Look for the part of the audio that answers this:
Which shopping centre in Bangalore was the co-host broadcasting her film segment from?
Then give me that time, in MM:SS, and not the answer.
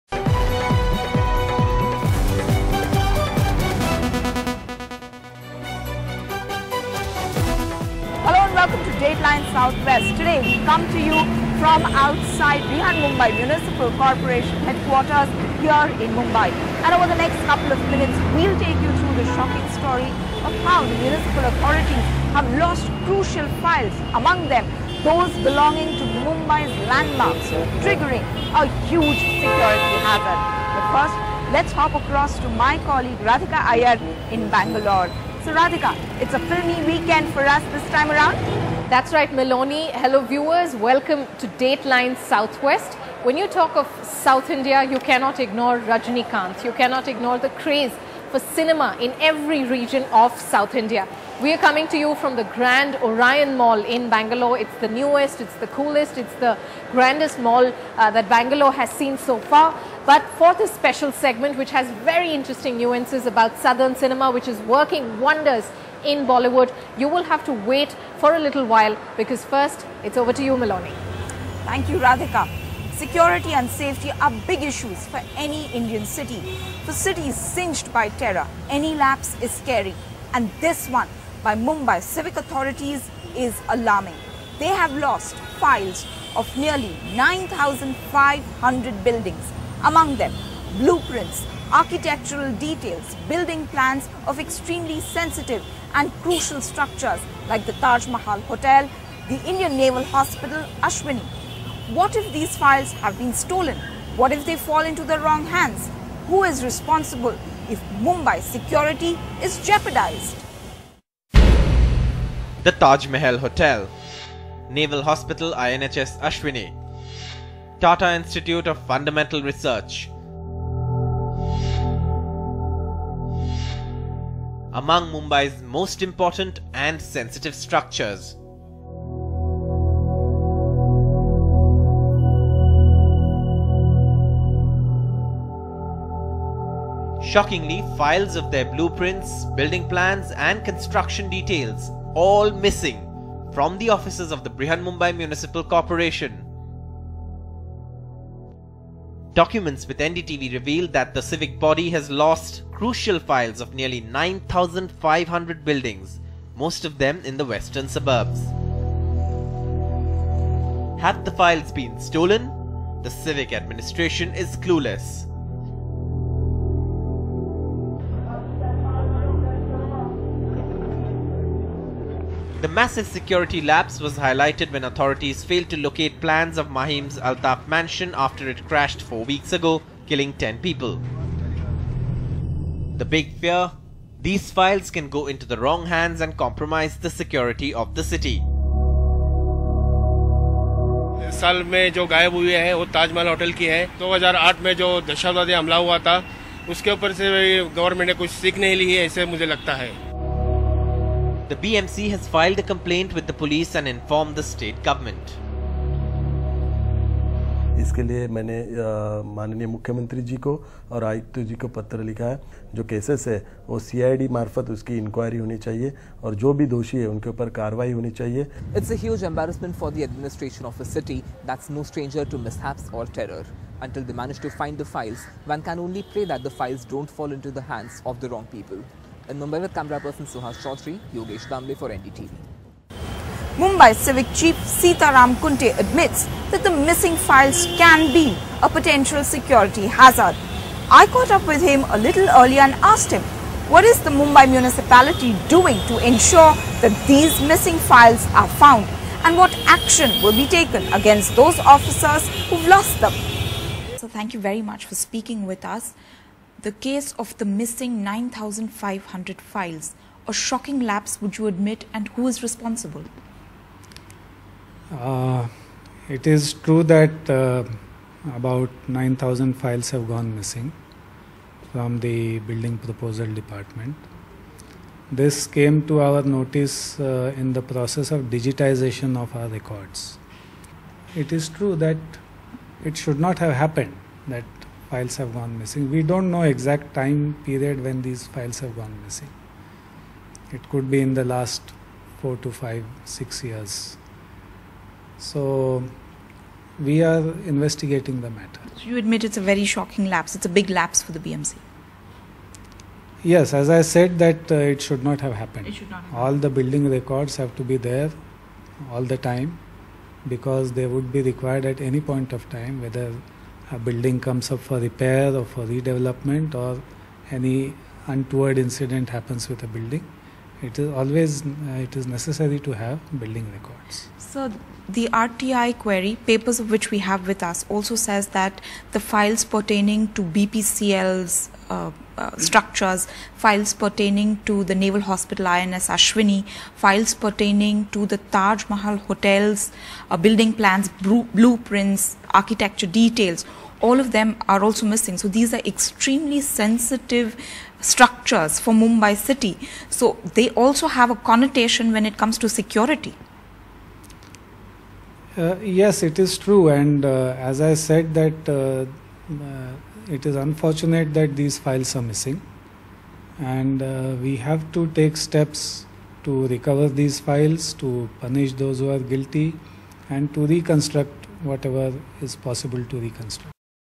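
00:52.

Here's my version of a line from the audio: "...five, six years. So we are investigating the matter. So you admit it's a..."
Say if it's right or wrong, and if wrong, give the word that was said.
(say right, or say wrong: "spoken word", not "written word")
right.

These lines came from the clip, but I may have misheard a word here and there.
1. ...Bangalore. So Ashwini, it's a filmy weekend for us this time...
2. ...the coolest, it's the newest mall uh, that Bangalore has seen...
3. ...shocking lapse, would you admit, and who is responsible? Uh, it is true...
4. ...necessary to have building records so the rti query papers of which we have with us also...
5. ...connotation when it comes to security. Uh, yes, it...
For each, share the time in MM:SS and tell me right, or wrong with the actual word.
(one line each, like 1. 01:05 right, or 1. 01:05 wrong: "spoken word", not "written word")
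1. 00:34 wrong: "Radhika", not "Ashwini"
2. 00:55 wrong: "grandest", not "newest"
3. 04:20 right
4. 05:22 right
5. 05:51 right.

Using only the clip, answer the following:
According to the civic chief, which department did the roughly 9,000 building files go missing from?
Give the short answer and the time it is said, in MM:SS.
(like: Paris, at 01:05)
building proposal department, at 04:32.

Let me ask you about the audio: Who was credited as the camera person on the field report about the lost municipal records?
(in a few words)
Suhas Chaudhary.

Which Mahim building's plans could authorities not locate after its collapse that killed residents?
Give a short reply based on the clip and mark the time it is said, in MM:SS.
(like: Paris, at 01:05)
Altaf Manzil, at 02:57.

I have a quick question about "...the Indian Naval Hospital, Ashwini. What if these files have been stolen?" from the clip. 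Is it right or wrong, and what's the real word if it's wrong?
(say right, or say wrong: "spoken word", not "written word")
right.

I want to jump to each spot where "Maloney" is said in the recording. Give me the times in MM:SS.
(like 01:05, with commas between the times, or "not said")
00:39, 01:10.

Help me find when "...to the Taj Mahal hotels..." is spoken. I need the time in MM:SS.
05:37.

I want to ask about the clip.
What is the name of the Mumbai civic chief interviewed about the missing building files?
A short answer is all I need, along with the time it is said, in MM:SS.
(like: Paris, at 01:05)
Sitaram Kunte, at 03:54.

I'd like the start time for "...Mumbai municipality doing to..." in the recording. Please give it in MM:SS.
04:04.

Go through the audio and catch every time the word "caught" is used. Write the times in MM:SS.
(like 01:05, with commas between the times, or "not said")
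04:01.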